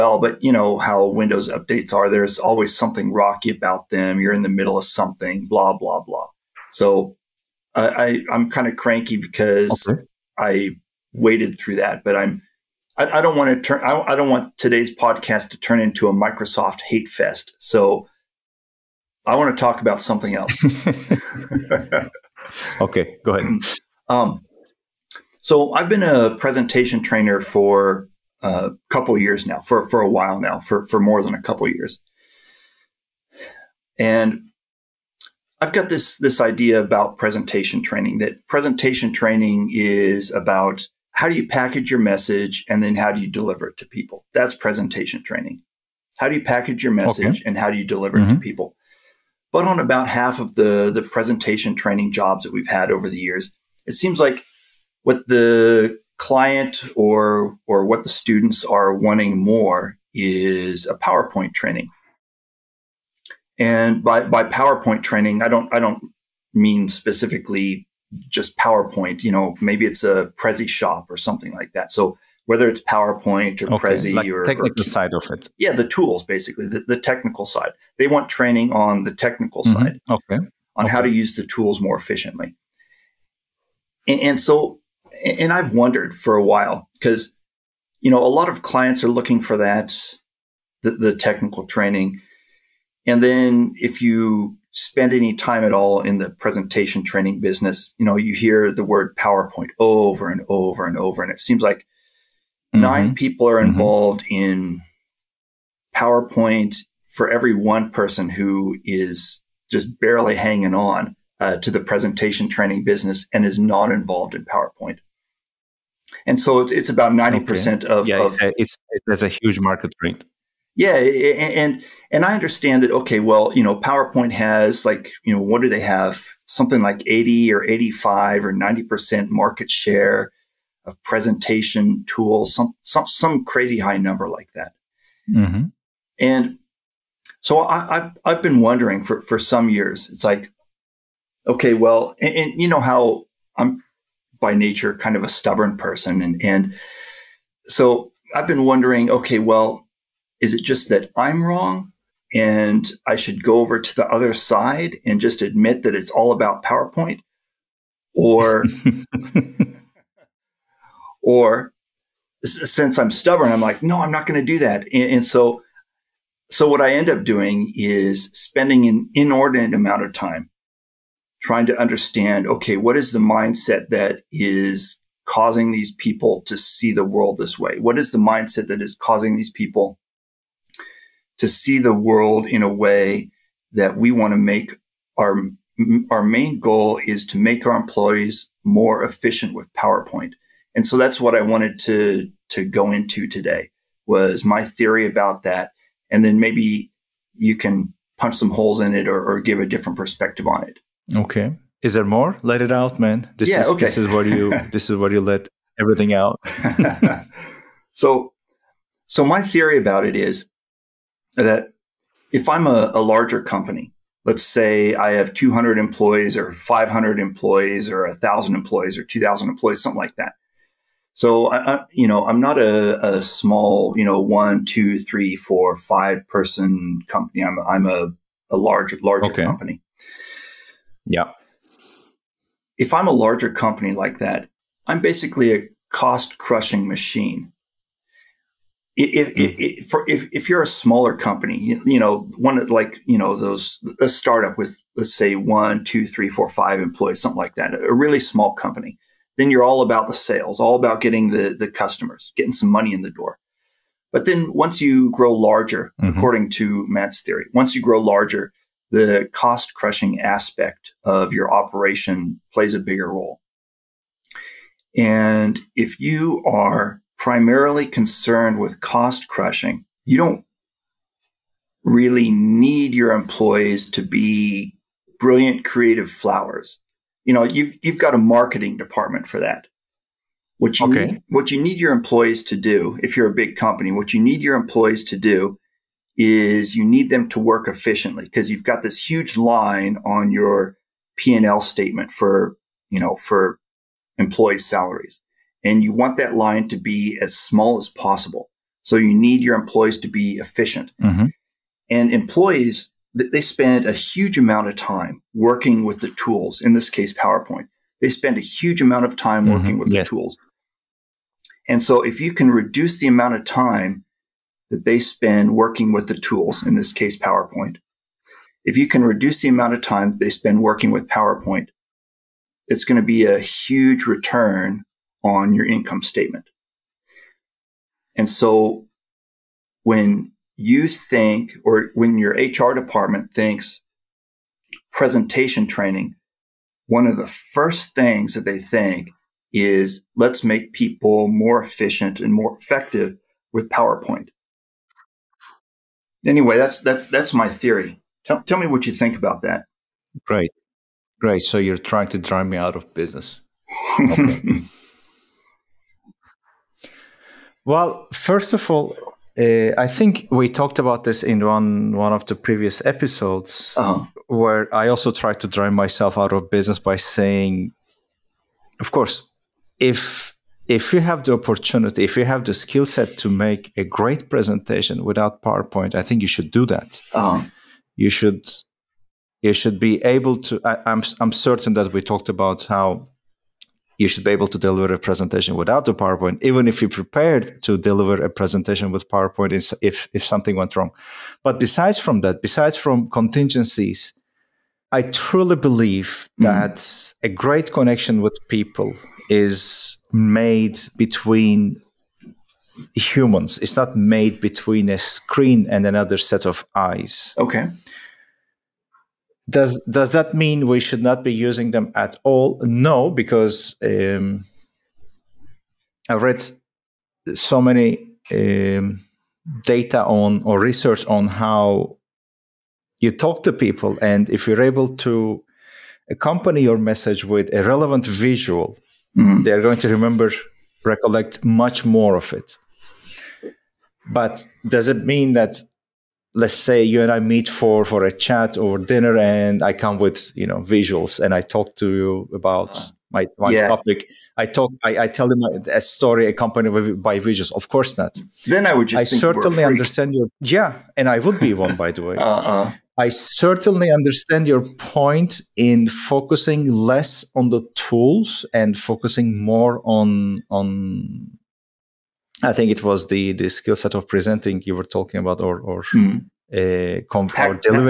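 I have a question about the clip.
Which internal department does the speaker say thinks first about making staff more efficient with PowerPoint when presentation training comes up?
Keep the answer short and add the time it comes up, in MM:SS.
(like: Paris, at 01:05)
HR department, at 05:32.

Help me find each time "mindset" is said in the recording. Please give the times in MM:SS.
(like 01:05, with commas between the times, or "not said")
02:53, 02:58.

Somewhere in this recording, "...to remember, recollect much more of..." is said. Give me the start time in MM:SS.
07:09.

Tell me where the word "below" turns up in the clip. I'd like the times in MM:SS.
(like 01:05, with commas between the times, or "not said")
not said.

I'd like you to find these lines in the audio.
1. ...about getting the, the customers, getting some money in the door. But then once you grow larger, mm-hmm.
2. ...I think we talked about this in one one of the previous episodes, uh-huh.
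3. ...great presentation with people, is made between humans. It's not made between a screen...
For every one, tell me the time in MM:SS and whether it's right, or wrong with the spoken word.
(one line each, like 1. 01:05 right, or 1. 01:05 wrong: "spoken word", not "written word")
1. 04:10 right
2. 05:59 right
3. 06:37 wrong: "connection", not "presentation".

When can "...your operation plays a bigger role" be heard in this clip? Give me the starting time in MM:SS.
04:21.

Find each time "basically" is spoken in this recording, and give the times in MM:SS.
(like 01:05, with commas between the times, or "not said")
01:16, 03:54.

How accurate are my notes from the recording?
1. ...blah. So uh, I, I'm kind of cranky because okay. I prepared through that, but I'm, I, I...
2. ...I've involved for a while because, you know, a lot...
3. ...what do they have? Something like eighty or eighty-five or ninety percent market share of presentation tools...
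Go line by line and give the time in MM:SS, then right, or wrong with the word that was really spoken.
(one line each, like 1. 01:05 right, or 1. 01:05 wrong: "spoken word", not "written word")
1. 00:05 wrong: "waded", not "prepared"
2. 01:25 wrong: "wondered", not "involved"
3. 02:05 right.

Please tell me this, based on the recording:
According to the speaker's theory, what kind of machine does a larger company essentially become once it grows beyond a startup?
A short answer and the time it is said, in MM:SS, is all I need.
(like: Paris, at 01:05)
cost crushing machine, at 03:55.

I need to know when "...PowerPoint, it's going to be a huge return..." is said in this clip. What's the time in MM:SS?
05:21.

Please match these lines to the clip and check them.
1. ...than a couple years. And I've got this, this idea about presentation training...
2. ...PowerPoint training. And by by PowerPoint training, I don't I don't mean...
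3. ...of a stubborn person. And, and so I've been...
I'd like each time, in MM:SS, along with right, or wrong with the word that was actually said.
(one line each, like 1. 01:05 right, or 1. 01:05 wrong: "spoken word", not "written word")
1. 00:31 right
2. 01:00 right
3. 02:25 right.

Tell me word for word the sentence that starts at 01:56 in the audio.
And so it's, it's about 90% okay.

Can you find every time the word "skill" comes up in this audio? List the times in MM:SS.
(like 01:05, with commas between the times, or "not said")
06:12, 07:43.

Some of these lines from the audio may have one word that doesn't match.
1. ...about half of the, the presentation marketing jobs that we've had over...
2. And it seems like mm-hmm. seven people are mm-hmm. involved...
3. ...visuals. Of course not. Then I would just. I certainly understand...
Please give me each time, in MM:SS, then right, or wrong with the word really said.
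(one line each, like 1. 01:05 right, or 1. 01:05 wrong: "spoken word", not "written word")
1. 00:49 wrong: "training", not "marketing"
2. 01:41 wrong: "nine", not "seven"
3. 07:27 right.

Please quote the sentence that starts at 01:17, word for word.
They want training on the technical mm-hmm.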